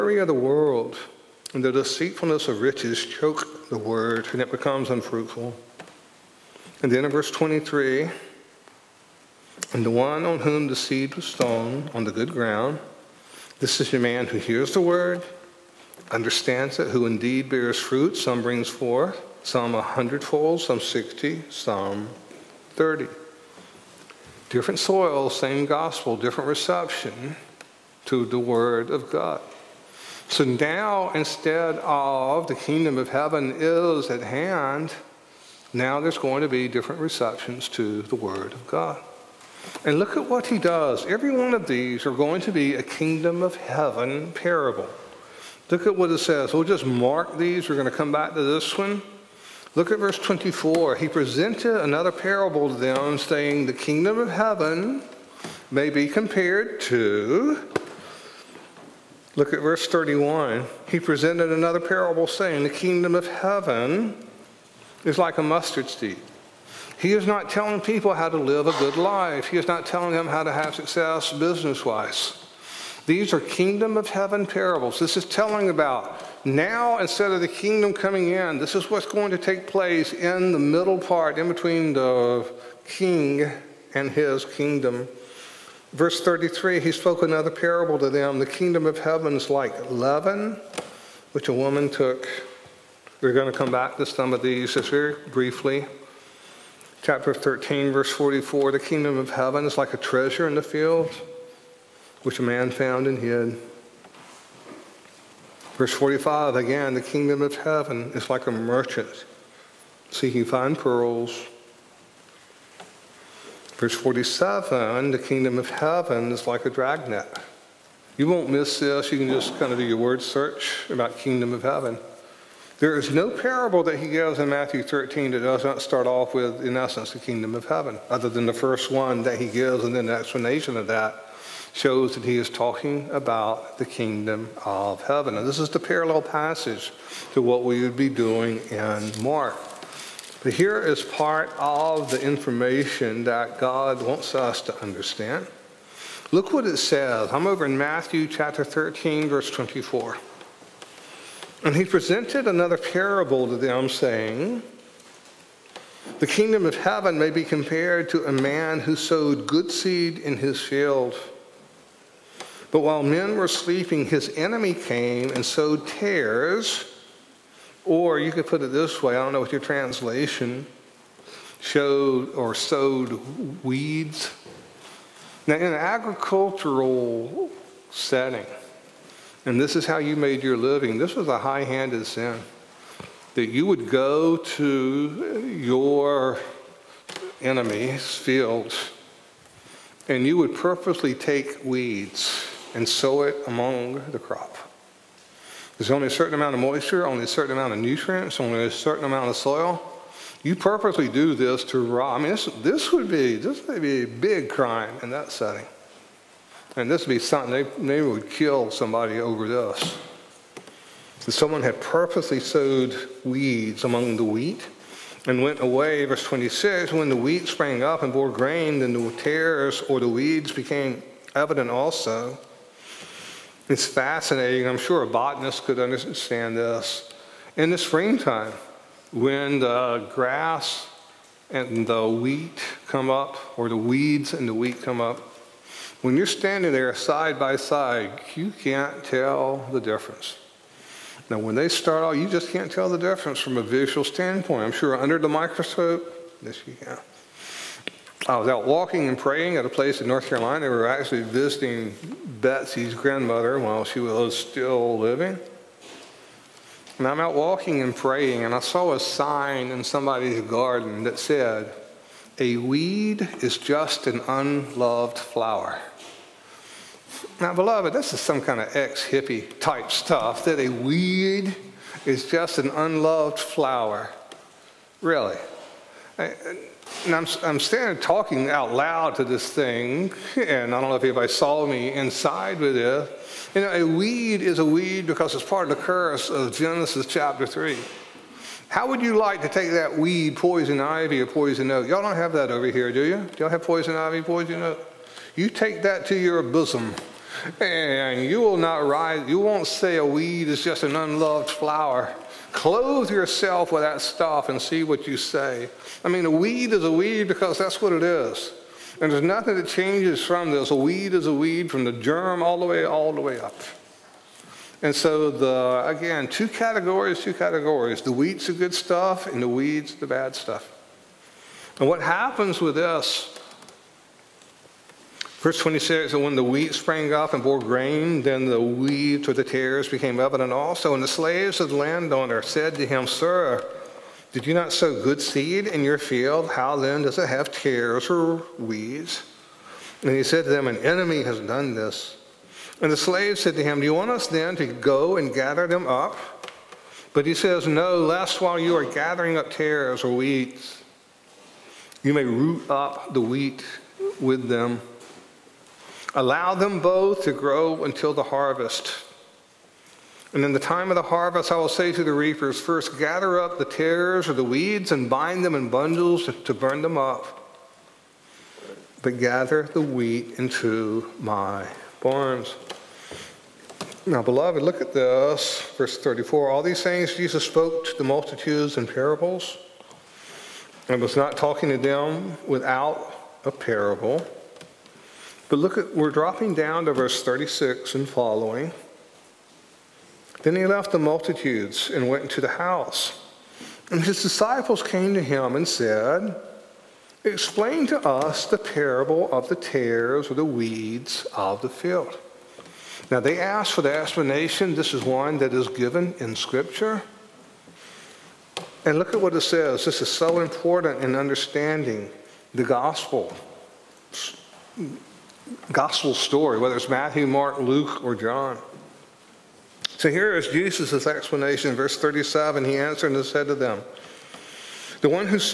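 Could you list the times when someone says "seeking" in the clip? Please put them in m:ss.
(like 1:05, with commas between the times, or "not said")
1:50.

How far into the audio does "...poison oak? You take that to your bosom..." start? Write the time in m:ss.
4:54.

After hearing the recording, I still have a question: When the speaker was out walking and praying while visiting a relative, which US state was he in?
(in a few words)
North Carolina.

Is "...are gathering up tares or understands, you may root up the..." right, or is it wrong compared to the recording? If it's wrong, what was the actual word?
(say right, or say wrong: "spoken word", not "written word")
wrong: "weeds", not "understands".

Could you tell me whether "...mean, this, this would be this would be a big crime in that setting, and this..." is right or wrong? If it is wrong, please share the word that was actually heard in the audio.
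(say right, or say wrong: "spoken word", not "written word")
right.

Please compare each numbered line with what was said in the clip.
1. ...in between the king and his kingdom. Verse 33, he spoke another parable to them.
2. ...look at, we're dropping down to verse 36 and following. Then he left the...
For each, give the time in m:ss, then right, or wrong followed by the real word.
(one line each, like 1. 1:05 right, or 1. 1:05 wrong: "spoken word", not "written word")
1. 1:21 right
2. 6:25 right.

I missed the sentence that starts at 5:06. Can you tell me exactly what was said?
I mean, a weed is a weed because that's what it is.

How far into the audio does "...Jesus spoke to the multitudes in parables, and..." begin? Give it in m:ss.
6:17.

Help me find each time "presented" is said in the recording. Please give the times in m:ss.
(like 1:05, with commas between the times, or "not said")
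0:51, 1:00, 2:31.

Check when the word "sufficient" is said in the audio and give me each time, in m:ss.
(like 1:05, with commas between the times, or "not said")
not said.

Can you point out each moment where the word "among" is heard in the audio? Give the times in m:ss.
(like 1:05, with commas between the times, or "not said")
3:13, 3:33.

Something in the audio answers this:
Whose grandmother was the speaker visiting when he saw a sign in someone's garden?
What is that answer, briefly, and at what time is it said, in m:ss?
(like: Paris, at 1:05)
Betsy's, at 4:12.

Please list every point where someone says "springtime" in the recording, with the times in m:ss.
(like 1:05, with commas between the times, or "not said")
3:47.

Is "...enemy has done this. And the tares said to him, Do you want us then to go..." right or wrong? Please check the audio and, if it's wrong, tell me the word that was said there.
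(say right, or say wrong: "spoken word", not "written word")
wrong: "slaves", not "tares".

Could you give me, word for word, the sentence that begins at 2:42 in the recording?
But while men were sleeping, his enemy came and sowed tares.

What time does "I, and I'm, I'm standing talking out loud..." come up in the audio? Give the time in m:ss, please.
4:36.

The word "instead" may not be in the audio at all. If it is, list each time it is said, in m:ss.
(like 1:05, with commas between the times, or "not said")
0:31, 1:16.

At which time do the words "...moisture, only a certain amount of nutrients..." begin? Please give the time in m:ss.
3:16.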